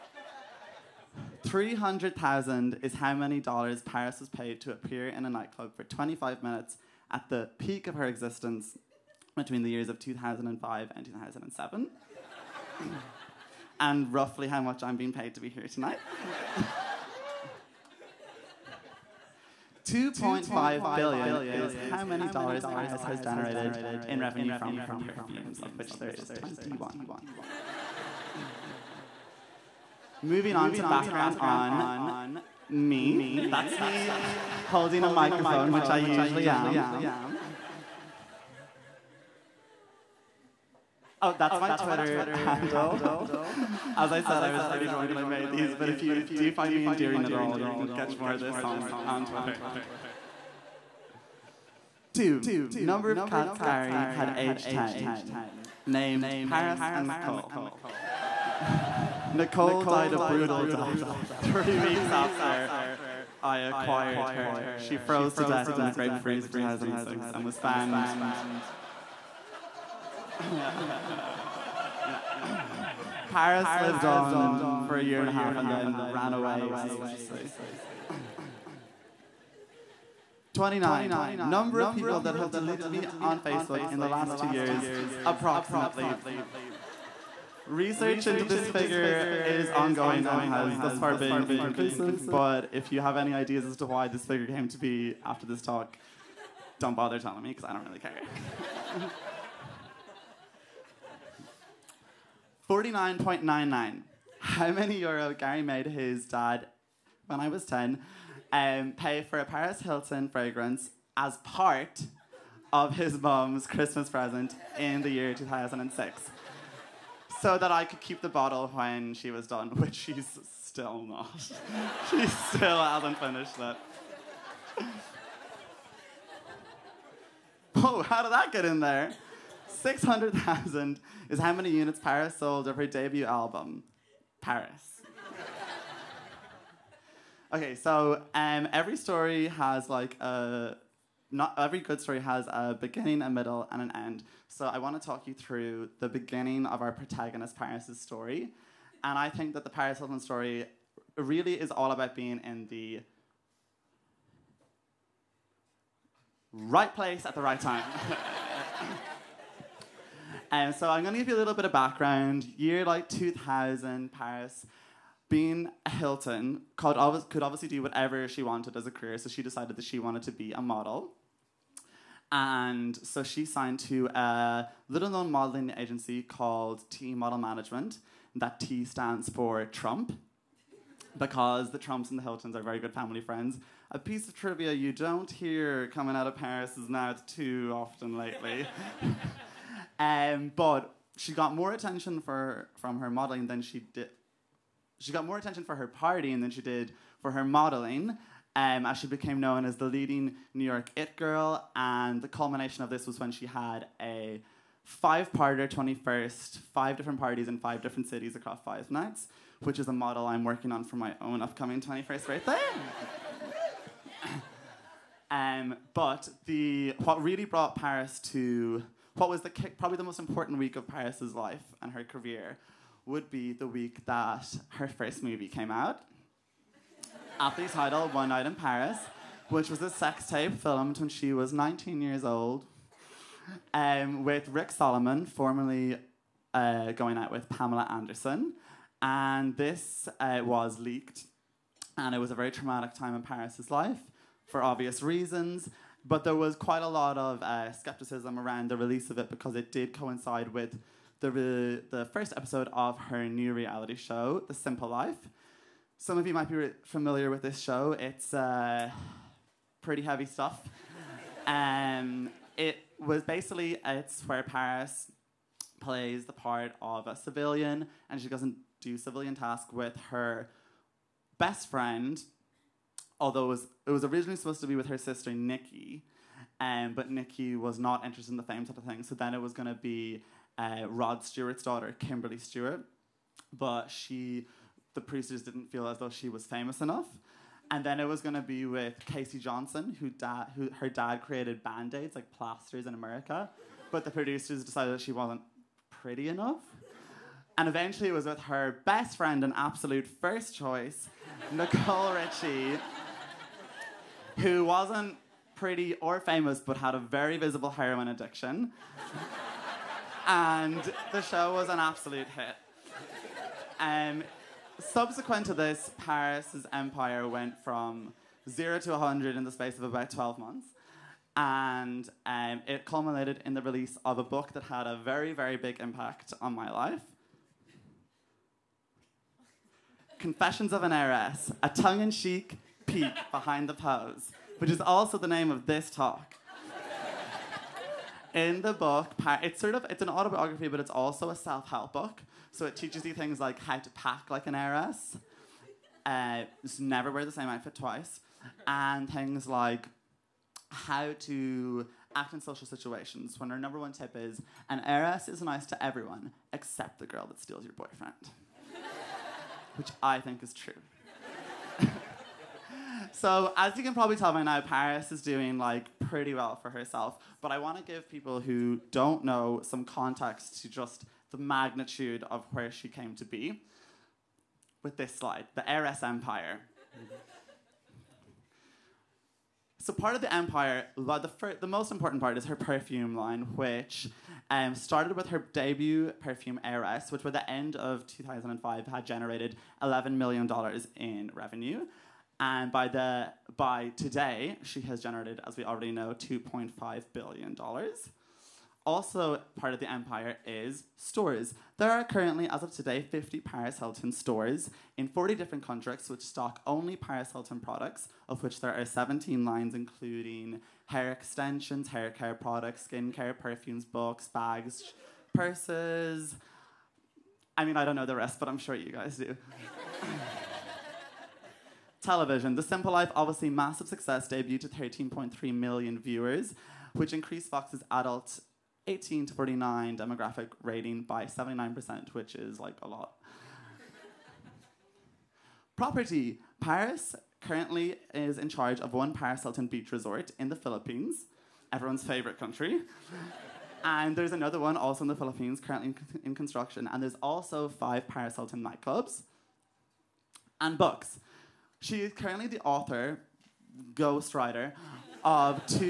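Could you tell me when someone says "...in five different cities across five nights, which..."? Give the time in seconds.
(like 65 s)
207 s.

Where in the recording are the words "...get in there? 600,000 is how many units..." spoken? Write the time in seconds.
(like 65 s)
128 s.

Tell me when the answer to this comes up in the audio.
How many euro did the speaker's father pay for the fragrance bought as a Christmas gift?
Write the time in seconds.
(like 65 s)
102 s.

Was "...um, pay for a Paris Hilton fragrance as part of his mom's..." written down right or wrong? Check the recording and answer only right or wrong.
right.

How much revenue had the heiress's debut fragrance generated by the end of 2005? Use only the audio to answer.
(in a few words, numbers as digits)
$11 million.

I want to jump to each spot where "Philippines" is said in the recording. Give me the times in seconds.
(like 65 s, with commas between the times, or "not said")
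440 s, 445 s.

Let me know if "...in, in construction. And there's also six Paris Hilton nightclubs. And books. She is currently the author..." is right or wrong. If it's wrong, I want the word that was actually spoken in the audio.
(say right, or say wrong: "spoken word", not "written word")
wrong: "five", not "six".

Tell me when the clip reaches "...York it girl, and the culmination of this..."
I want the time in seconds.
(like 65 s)
200 s.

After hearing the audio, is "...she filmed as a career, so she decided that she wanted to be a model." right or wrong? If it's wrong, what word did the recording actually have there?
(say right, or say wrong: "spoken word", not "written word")
wrong: "wanted", not "filmed".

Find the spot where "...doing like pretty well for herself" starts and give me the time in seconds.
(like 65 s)
365 s.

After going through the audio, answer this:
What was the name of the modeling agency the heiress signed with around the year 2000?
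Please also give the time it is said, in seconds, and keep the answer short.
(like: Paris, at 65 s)
T Model Management, at 176 s.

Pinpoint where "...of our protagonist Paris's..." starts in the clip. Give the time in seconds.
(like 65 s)
146 s.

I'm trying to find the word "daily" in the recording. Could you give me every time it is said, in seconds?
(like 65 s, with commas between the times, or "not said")
not said.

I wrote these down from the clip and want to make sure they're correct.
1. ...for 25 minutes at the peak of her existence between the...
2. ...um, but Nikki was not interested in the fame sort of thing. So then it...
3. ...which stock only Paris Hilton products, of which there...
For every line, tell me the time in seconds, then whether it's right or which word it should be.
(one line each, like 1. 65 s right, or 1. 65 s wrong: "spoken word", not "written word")
1. 5 s right
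2. 276 s right
3. 406 s right.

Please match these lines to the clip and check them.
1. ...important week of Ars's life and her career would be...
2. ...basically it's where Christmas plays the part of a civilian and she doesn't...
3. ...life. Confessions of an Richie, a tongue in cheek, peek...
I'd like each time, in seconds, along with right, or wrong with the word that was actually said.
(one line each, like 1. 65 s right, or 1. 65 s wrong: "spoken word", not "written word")
1. 220 s wrong: "Paris", not "Ars"
2. 263 s wrong: "Paris", not "Christmas"
3. 326 s wrong: "Heiress", not "Richie".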